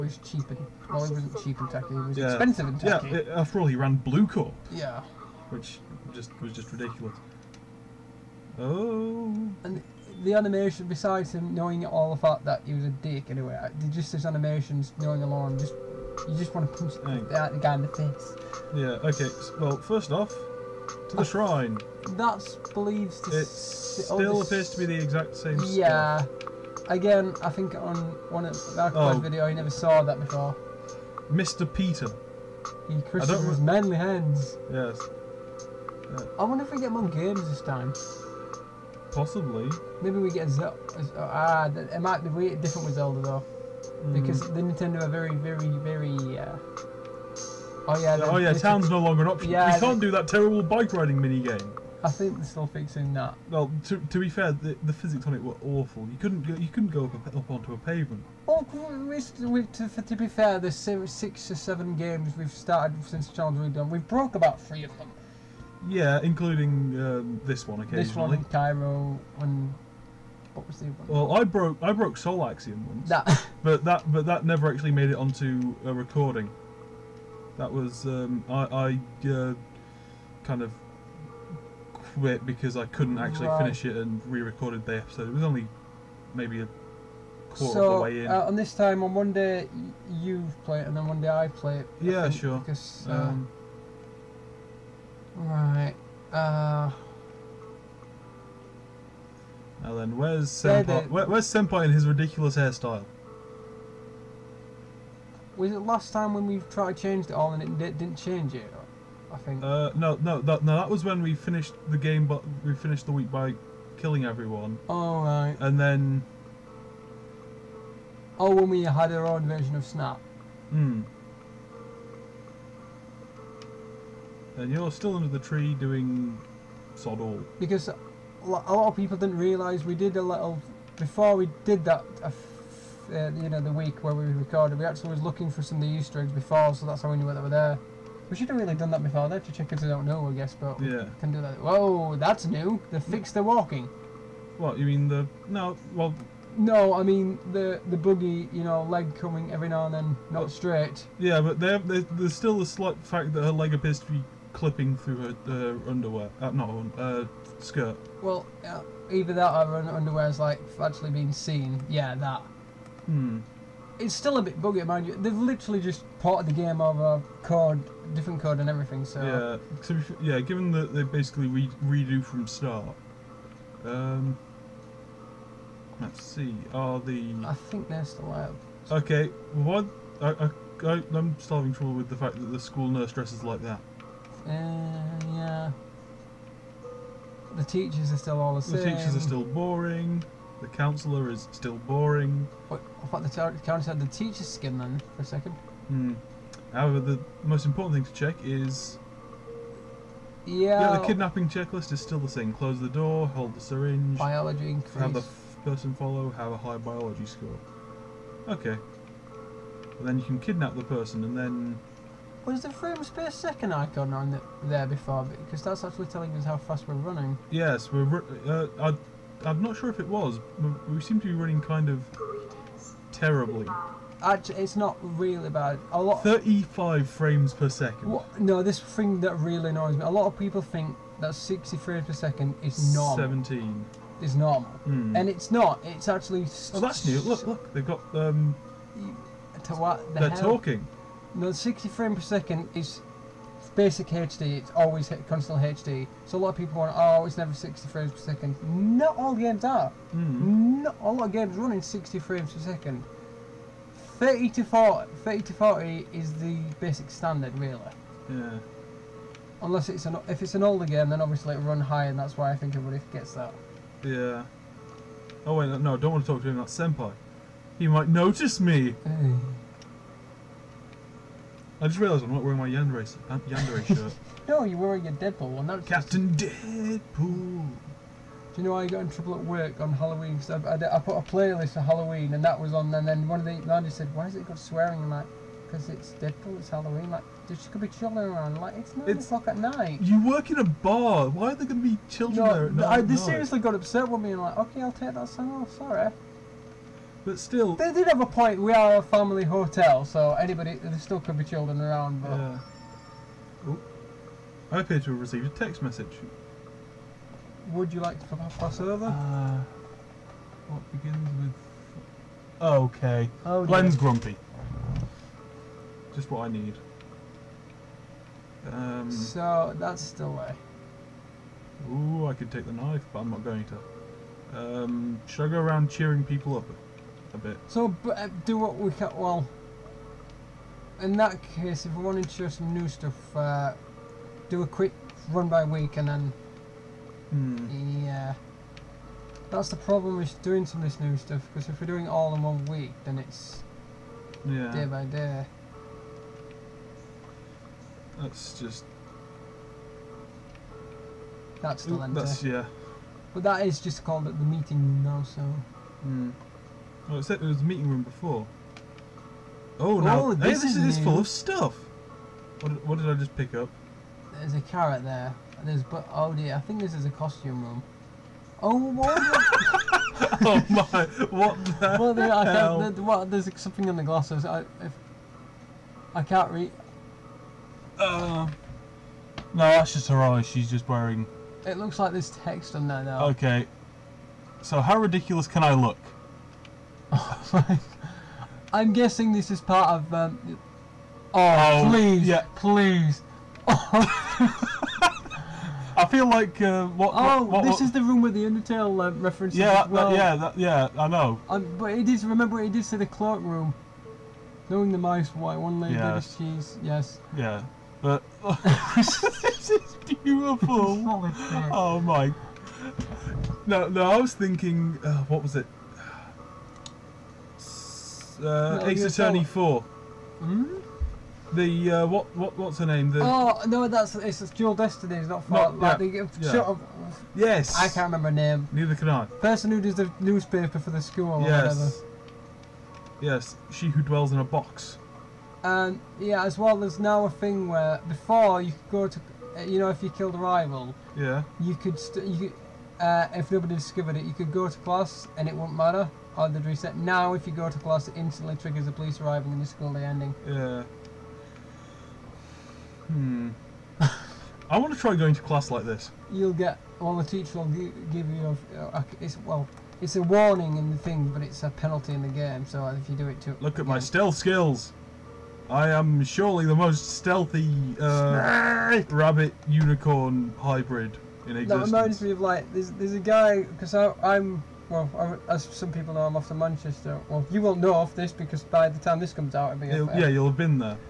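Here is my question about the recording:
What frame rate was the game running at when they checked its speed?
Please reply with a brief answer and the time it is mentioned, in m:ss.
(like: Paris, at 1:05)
35 frames per second, at 3:46.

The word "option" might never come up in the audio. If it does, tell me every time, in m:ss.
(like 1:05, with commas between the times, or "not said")
0:49.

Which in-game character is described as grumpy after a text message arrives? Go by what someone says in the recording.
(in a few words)
Glenn.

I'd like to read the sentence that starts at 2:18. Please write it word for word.
We should have really done that before that to if who don't know, I guess, but yeah.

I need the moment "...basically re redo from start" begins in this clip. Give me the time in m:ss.
2:51.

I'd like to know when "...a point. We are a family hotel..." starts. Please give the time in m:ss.
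4:58.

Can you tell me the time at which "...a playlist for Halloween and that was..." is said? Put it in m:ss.
4:41.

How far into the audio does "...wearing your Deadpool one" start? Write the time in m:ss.
4:34.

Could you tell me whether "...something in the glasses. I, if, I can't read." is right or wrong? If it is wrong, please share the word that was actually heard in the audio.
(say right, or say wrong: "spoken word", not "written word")
right.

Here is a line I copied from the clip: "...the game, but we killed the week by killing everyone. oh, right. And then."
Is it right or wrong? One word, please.
wrong.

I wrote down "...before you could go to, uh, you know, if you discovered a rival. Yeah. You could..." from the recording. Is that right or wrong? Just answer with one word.
wrong.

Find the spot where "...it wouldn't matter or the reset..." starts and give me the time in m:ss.
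7:25.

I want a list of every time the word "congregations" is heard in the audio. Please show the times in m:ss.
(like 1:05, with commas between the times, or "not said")
not said.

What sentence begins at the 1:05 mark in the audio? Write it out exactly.
Yeah, including um, this one occasionally.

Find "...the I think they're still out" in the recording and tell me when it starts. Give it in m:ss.
2:56.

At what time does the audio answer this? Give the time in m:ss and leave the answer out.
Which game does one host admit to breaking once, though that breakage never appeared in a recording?
1:12.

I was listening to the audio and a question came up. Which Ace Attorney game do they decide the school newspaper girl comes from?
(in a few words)
Dual Destiny.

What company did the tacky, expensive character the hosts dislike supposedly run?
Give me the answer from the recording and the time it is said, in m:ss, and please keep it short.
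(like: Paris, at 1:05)
Bluecorp, at 0:04.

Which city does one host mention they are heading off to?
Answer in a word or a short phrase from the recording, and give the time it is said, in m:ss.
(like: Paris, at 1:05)
Manchester, at 7:56.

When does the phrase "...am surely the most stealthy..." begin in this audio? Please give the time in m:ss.
7:45.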